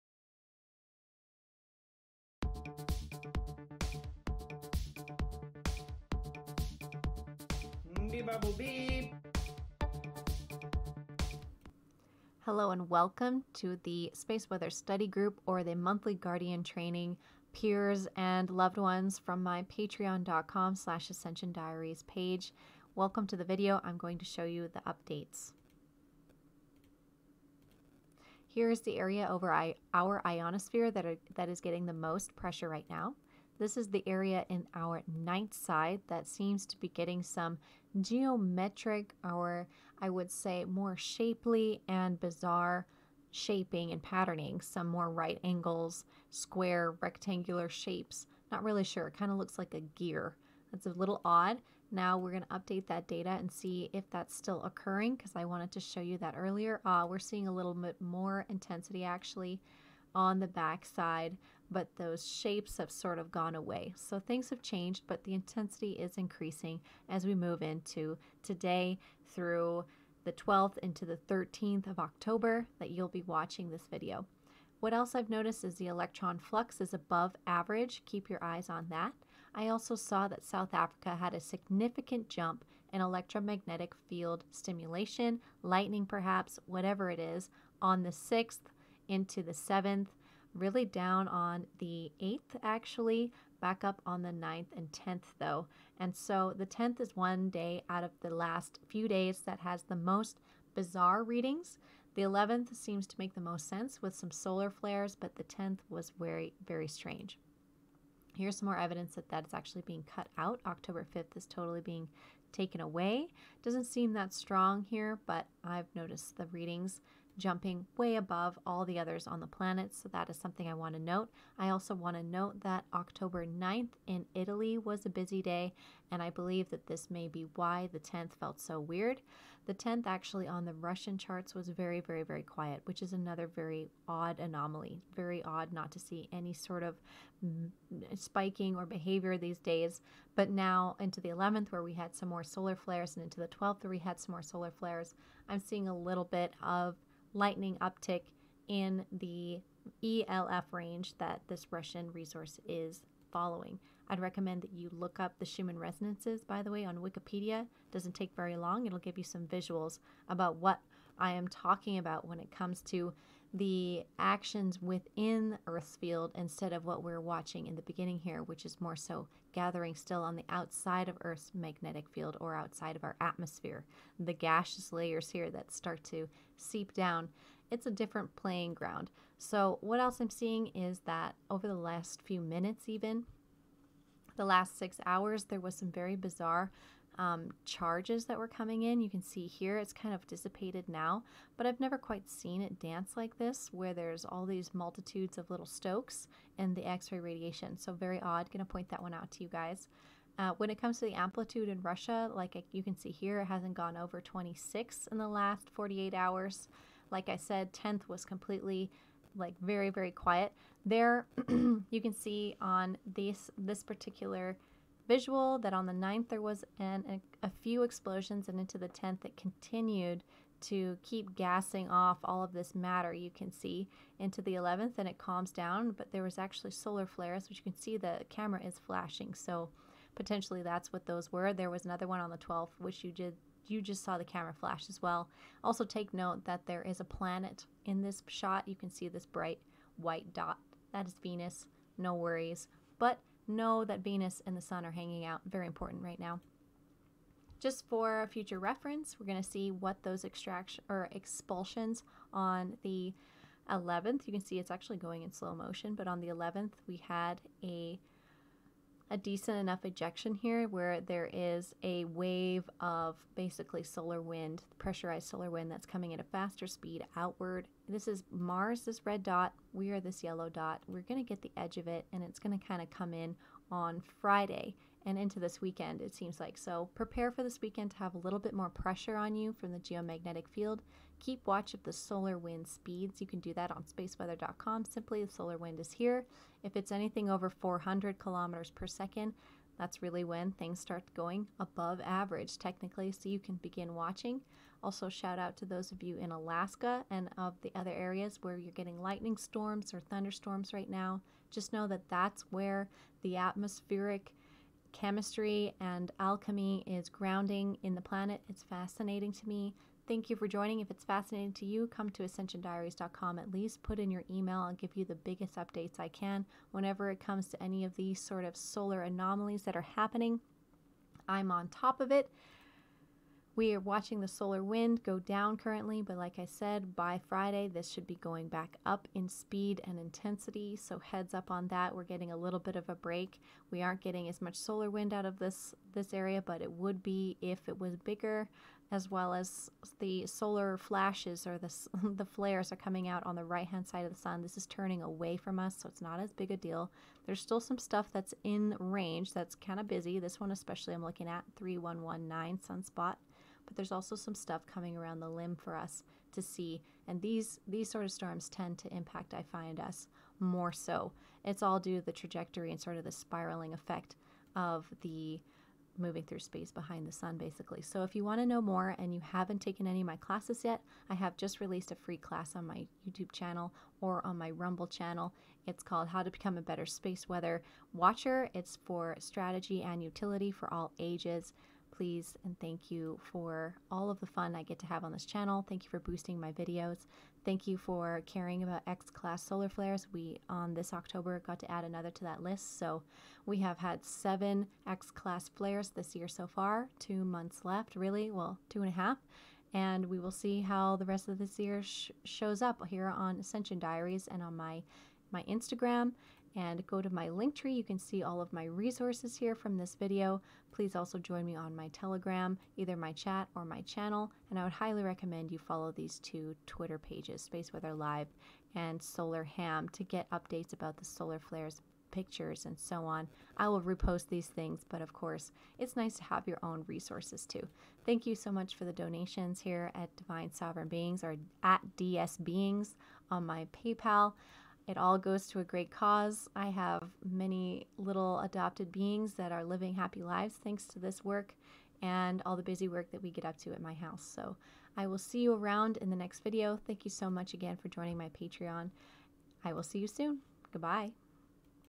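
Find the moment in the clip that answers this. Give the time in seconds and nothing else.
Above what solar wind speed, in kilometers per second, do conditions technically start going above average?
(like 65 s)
287 s.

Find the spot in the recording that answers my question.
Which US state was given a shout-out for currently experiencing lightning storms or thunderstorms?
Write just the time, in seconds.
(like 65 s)
296 s.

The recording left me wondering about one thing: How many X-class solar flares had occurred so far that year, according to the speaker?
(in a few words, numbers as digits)
7.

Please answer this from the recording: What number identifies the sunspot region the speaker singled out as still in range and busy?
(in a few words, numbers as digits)
3119.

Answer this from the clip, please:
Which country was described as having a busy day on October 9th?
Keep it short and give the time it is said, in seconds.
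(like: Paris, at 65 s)
Italy, at 124 s.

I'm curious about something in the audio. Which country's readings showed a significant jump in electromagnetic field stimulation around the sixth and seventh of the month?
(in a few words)
South Africa.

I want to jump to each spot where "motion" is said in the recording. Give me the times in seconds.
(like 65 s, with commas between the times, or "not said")
255 s.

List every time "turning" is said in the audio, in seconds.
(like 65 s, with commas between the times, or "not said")
344 s.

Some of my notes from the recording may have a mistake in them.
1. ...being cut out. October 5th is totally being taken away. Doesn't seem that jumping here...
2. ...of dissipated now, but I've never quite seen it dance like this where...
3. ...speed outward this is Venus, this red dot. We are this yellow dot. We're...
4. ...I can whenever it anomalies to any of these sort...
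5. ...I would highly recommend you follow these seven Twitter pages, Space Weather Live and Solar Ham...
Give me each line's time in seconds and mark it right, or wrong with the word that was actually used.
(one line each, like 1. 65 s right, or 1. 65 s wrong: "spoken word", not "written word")
1. 109 s wrong: "strong", not "jumping"
2. 190 s right
3. 266 s wrong: "Mars", not "Venus"
4. 315 s wrong: "comes", not "anomalies"
5. 414 s wrong: "two", not "seven".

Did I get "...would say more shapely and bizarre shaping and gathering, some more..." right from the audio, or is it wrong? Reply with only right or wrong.
wrong.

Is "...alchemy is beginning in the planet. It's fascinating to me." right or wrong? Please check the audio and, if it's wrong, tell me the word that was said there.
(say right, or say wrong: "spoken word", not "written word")
wrong: "grounding", not "beginning".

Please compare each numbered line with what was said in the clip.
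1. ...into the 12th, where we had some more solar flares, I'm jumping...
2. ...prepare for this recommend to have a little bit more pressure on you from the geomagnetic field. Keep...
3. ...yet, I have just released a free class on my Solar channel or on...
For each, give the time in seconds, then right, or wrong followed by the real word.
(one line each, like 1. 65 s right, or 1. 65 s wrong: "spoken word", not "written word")
1. 143 s wrong: "seeing", not "jumping"
2. 276 s wrong: "weekend", not "recommend"
3. 370 s wrong: "YouTube", not "Solar".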